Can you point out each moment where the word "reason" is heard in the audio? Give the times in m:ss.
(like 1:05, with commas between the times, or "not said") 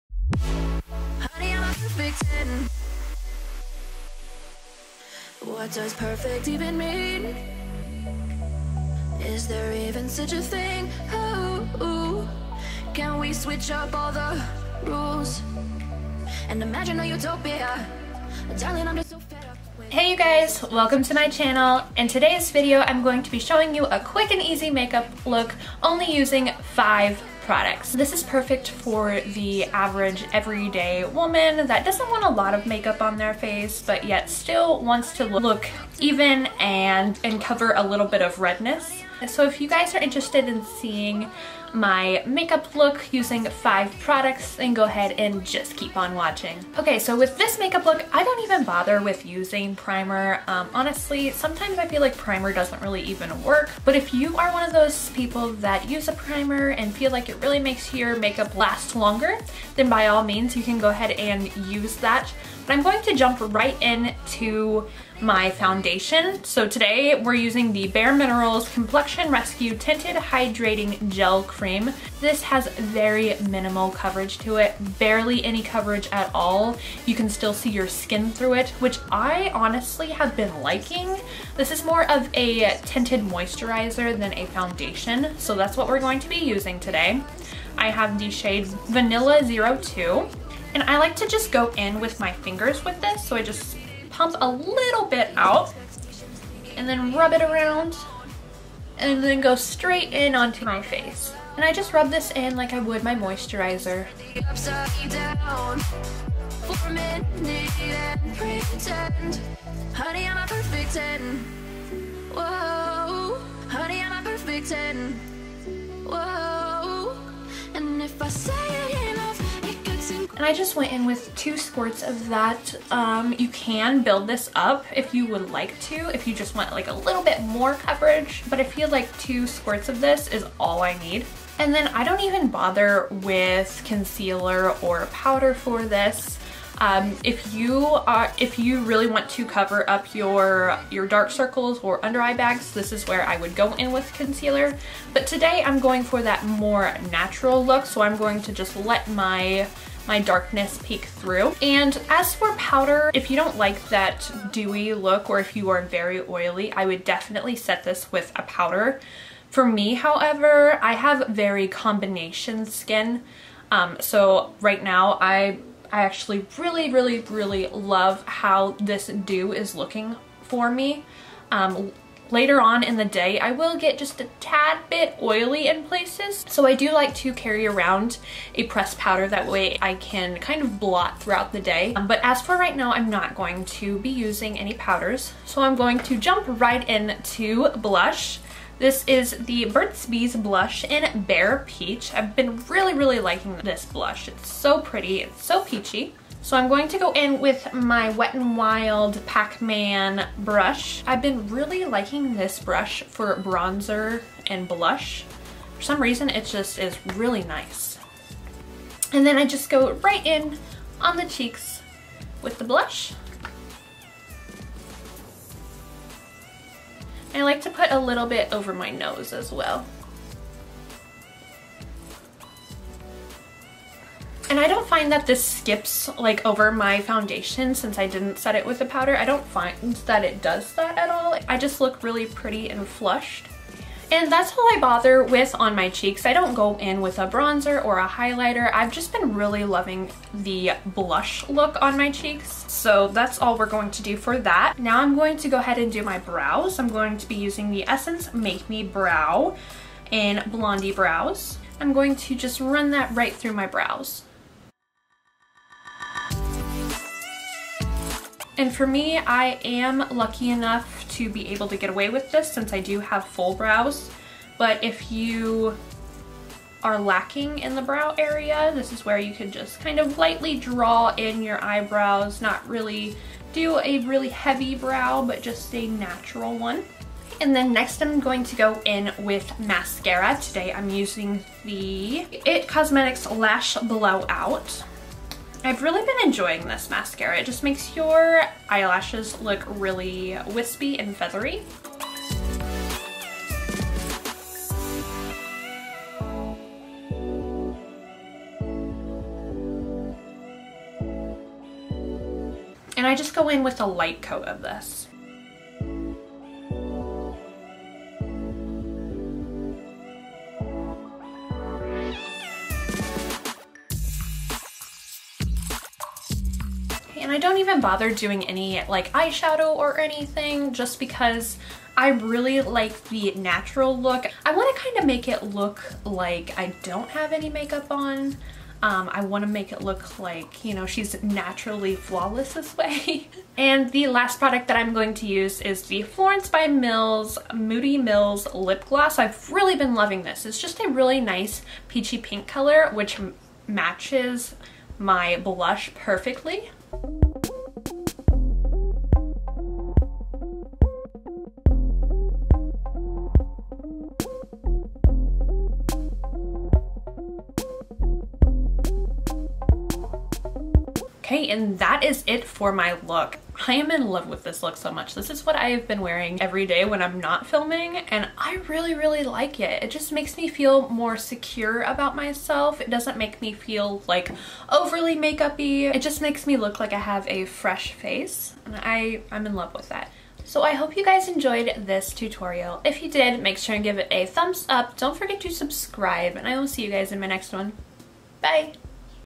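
3:26.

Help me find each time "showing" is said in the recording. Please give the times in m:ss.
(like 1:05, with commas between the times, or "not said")
0:23.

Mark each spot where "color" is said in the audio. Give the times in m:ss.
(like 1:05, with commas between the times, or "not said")
5:42.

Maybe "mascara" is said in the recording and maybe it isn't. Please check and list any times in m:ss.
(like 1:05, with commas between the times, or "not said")
4:39, 4:46.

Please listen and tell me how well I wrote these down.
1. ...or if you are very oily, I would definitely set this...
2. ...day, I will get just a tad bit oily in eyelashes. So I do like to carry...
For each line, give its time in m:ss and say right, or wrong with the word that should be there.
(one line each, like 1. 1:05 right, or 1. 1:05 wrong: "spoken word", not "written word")
1. 2:35 right
2. 2:53 wrong: "places", not "eyelashes".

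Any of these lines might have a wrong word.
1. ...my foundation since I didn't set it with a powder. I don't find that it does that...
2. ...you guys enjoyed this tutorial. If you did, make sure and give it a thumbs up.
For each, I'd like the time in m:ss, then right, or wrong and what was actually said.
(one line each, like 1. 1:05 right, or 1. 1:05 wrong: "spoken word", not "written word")
1. 3:46 right
2. 6:20 right.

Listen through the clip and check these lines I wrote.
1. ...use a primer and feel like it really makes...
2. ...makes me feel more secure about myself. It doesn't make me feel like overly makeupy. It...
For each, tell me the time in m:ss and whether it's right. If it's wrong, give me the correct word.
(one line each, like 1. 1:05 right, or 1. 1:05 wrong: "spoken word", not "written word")
1. 0:55 right
2. 6:10 right.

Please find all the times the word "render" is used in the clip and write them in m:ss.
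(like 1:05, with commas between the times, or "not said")
not said.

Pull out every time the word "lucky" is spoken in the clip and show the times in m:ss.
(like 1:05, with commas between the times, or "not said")
4:20.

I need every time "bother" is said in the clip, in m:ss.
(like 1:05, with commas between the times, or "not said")
0:48, 2:12, 3:54, 5:17.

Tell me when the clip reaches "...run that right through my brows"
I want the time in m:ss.
4:12.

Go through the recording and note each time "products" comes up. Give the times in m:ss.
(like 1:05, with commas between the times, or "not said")
0:27, 0:43, 5:34.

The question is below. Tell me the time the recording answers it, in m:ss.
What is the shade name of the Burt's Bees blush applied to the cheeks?
3:11.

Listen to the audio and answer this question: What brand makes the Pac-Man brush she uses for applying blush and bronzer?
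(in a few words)
Wet n Wild.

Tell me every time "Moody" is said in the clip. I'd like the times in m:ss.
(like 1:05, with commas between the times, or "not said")
5:37.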